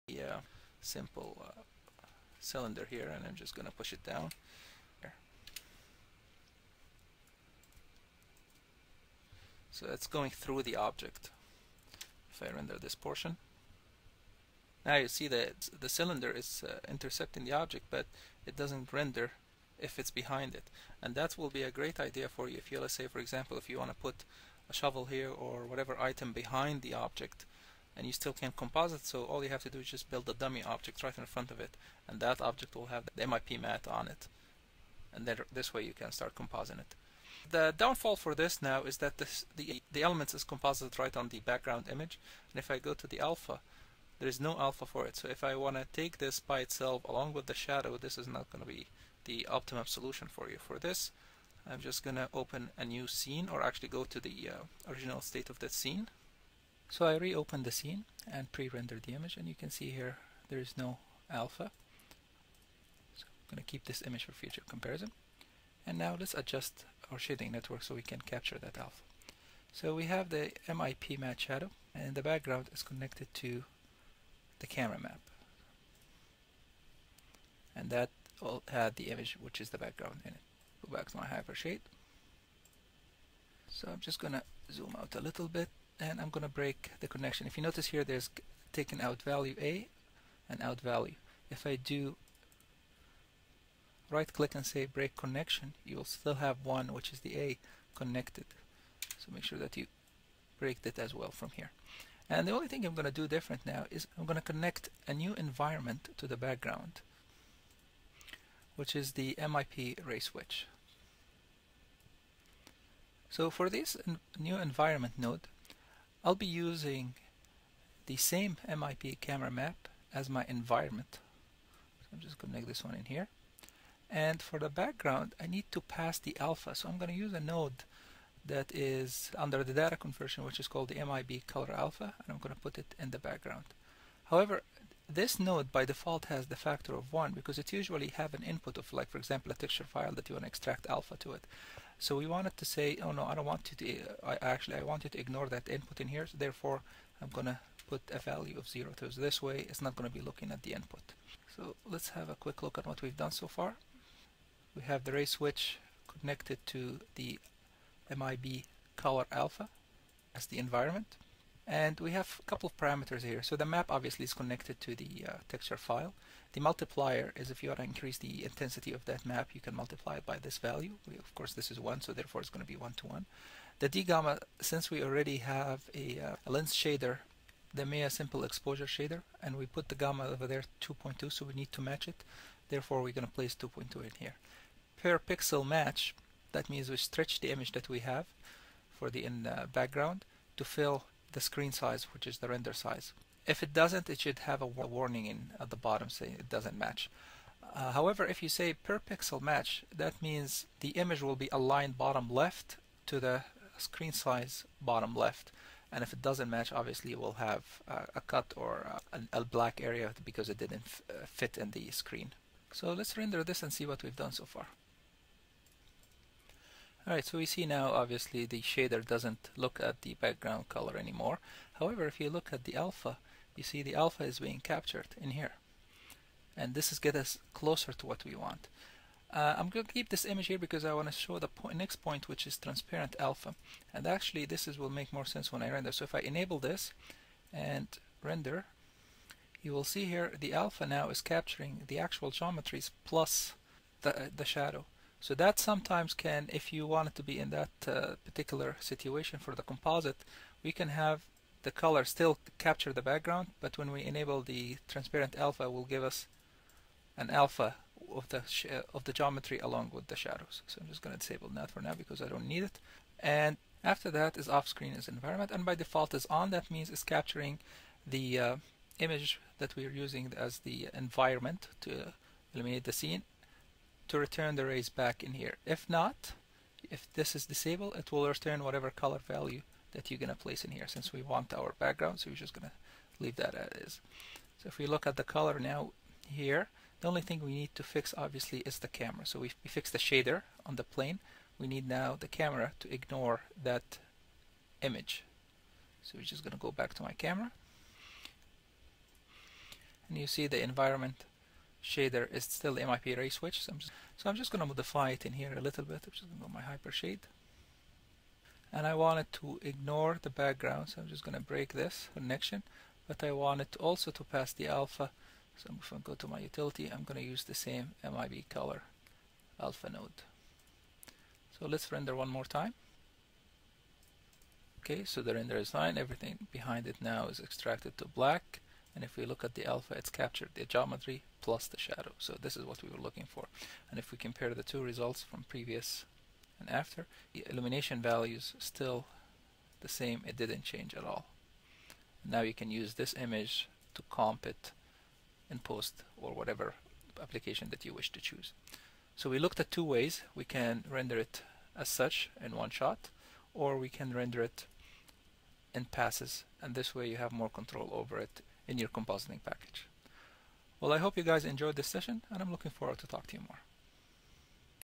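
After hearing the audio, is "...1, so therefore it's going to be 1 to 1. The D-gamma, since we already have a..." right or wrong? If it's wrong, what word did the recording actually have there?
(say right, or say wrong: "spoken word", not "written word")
right.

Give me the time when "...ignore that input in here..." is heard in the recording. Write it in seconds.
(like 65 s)
145 s.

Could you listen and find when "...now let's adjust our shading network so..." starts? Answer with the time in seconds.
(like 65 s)
65 s.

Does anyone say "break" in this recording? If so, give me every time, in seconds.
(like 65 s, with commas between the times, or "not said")
86 s, 94 s, 100 s, 311 s.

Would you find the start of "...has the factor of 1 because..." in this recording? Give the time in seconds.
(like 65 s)
136 s.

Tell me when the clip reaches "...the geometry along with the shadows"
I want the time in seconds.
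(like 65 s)
259 s.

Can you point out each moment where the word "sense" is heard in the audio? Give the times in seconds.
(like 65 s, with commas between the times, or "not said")
235 s.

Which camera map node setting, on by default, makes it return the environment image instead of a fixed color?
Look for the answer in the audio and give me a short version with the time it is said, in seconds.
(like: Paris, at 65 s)
off screen is environment, at 264 s.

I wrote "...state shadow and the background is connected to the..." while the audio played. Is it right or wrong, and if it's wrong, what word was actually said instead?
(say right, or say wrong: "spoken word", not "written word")
wrong: "matte", not "state".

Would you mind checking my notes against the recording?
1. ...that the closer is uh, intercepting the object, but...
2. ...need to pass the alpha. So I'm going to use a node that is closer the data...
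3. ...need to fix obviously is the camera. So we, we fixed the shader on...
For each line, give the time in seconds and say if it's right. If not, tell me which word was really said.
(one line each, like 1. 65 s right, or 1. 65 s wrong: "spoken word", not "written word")
1. 15 s wrong: "cylinder", not "closer"
2. 125 s wrong: "under", not "closer"
3. 287 s right.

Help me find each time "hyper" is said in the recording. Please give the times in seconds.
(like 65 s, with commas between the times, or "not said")
81 s, 306 s.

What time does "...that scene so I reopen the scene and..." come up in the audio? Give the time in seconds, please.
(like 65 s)
55 s.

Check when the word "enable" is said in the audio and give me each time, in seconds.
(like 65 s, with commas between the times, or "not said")
236 s, 254 s.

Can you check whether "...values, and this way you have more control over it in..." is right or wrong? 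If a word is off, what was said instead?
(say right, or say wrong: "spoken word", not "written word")
wrong: "passes", not "values".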